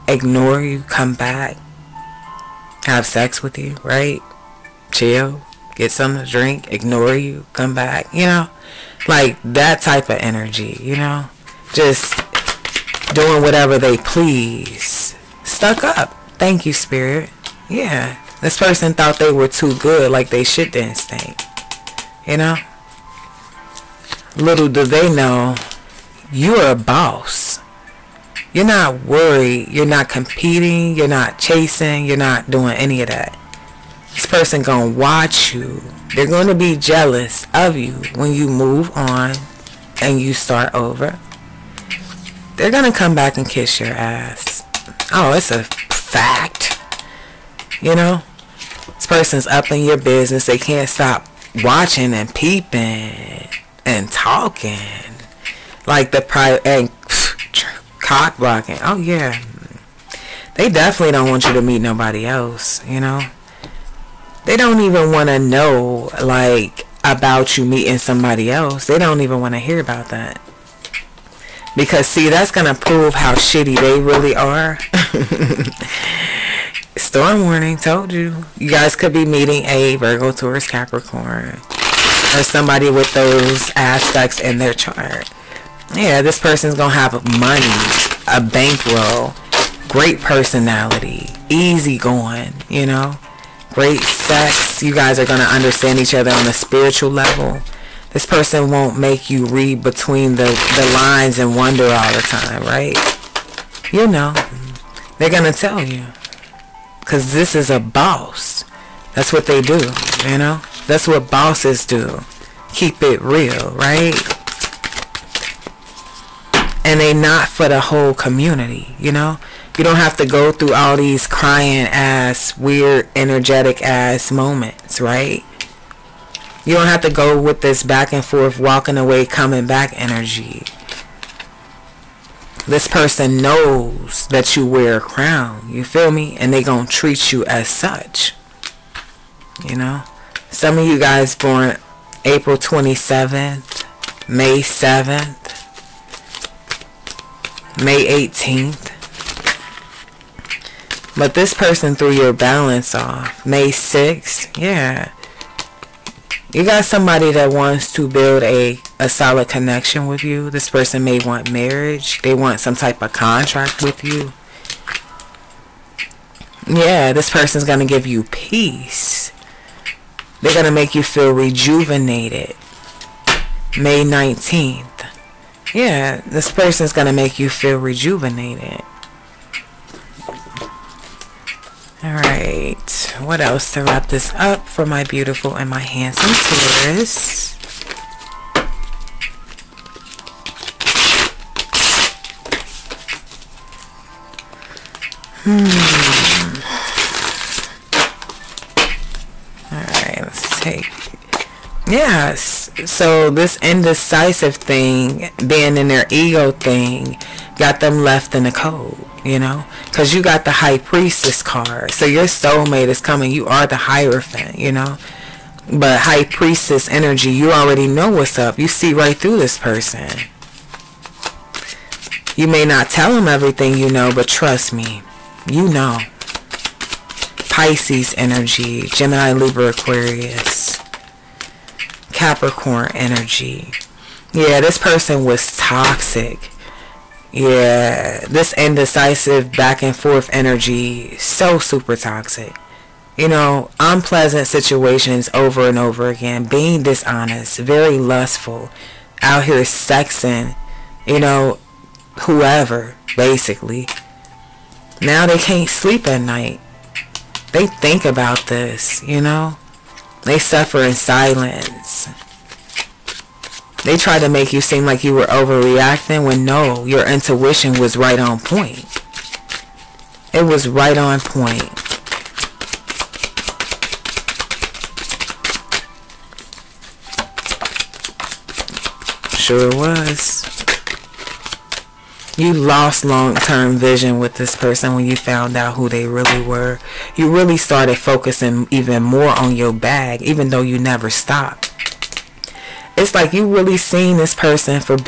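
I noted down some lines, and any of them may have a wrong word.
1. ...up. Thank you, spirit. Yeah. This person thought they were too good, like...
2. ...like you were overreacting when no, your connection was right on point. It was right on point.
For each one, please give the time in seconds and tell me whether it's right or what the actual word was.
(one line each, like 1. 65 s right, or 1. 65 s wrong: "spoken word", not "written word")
1. 15 s right
2. 264 s wrong: "intuition", not "connection".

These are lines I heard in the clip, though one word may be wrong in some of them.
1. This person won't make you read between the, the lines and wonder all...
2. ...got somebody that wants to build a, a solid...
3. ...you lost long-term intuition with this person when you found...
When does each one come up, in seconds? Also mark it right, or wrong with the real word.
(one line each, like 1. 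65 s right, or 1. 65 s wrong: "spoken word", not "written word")
1. 98 s right
2. 156 s right
3. 282 s wrong: "vision", not "intuition".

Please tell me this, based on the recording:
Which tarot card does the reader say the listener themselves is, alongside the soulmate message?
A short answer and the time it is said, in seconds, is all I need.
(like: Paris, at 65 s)
The Hierophant, at 213 s.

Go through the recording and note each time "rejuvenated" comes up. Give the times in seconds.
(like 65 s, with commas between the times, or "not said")
171 s, 177 s.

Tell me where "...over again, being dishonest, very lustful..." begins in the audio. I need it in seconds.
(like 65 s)
245 s.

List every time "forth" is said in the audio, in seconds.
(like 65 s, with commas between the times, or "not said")
128 s, 239 s.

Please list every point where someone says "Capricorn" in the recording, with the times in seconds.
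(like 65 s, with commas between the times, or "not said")
80 s, 232 s.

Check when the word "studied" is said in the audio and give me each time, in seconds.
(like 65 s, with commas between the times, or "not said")
not said.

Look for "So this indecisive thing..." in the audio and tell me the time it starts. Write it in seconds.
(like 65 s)
202 s.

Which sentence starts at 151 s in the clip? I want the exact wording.
But this person threw your balance off.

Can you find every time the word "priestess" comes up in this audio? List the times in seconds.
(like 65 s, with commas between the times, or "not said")
210 s, 216 s.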